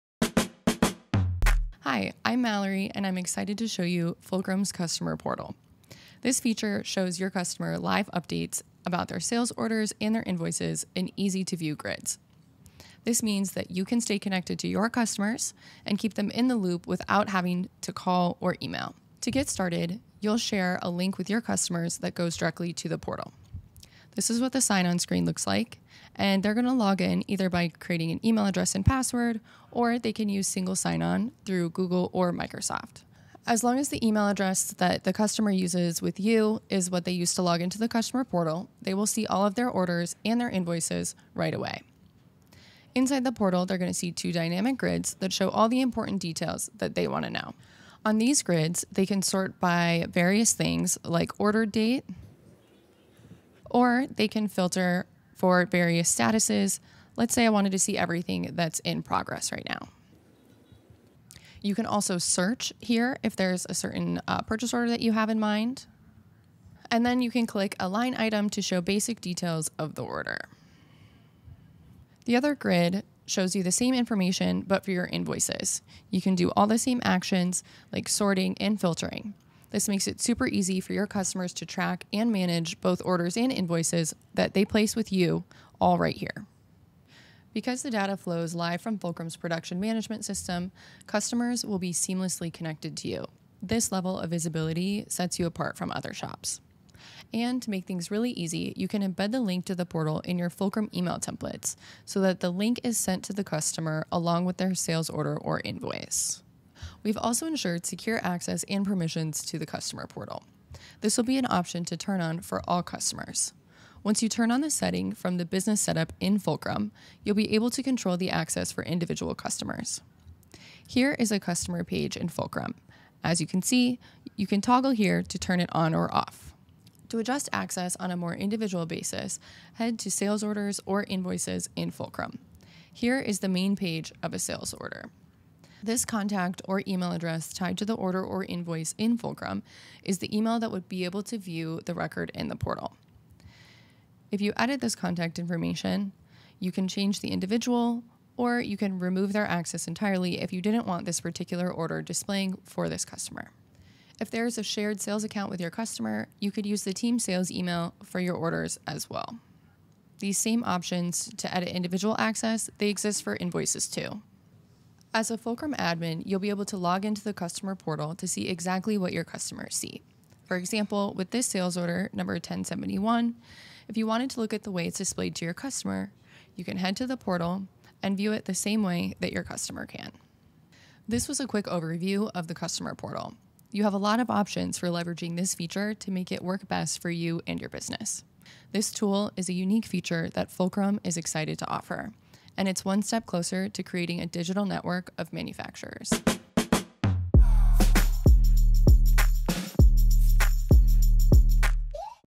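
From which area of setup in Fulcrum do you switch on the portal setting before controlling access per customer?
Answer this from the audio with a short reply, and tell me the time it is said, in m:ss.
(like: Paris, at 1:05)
business setup, at 1:55.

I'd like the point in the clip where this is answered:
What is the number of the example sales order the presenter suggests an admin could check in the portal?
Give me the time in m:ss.
2:52.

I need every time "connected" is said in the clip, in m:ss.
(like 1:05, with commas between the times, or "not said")
0:14, 1:32.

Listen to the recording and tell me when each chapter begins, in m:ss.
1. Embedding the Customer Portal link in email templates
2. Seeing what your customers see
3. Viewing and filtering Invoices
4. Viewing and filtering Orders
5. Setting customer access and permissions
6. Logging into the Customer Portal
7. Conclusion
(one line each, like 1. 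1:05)
1. 1:36
2. 2:45
3. 1:11
4. 0:42
5. 1:46
6. 0:19
7. 3:00.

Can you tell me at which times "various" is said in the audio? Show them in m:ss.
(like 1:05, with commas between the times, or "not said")
0:50, 0:55.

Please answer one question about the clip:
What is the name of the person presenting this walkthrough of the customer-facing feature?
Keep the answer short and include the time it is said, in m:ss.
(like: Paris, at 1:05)
Mallory, at 0:02.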